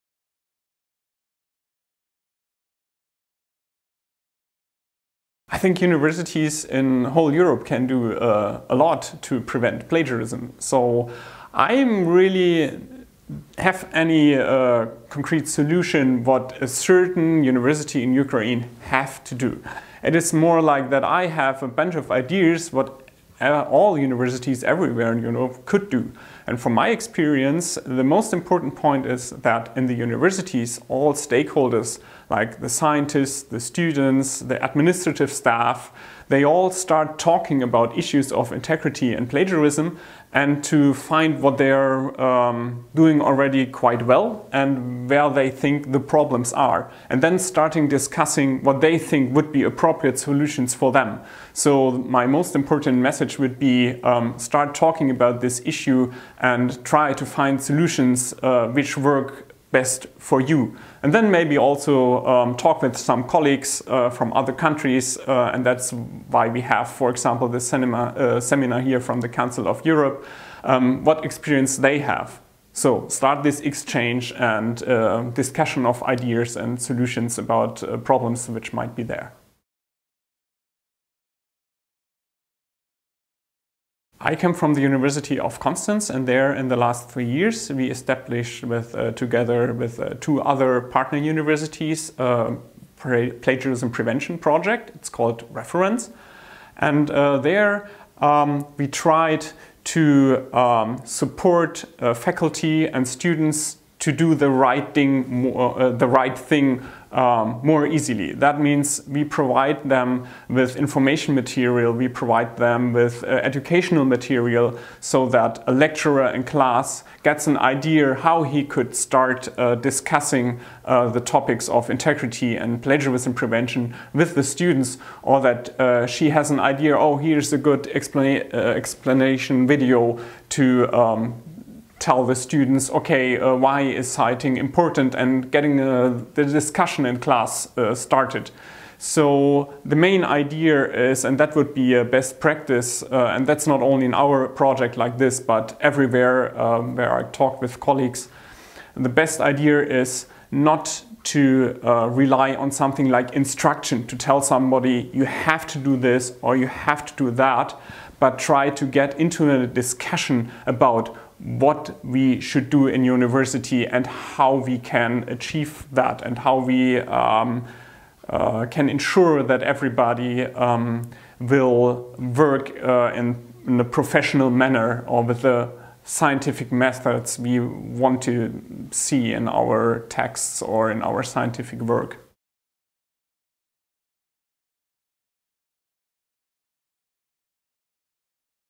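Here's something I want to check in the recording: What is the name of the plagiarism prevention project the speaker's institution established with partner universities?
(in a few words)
Reference.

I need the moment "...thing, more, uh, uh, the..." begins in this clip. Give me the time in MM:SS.
01:44.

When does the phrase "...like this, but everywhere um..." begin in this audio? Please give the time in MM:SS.
02:24.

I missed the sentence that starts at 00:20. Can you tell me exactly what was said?
It is more like that I have a bunch of ideas what uh, all universities everywhere in Europe could do.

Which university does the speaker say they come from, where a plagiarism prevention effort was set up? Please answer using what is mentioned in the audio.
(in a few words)
University of Konstanz.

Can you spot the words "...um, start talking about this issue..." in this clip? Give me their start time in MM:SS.
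00:54.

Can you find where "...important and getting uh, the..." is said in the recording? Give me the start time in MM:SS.
02:14.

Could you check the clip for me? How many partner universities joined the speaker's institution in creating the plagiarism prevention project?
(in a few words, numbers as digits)
2.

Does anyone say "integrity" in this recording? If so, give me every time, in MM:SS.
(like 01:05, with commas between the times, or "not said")
00:38, 02:01.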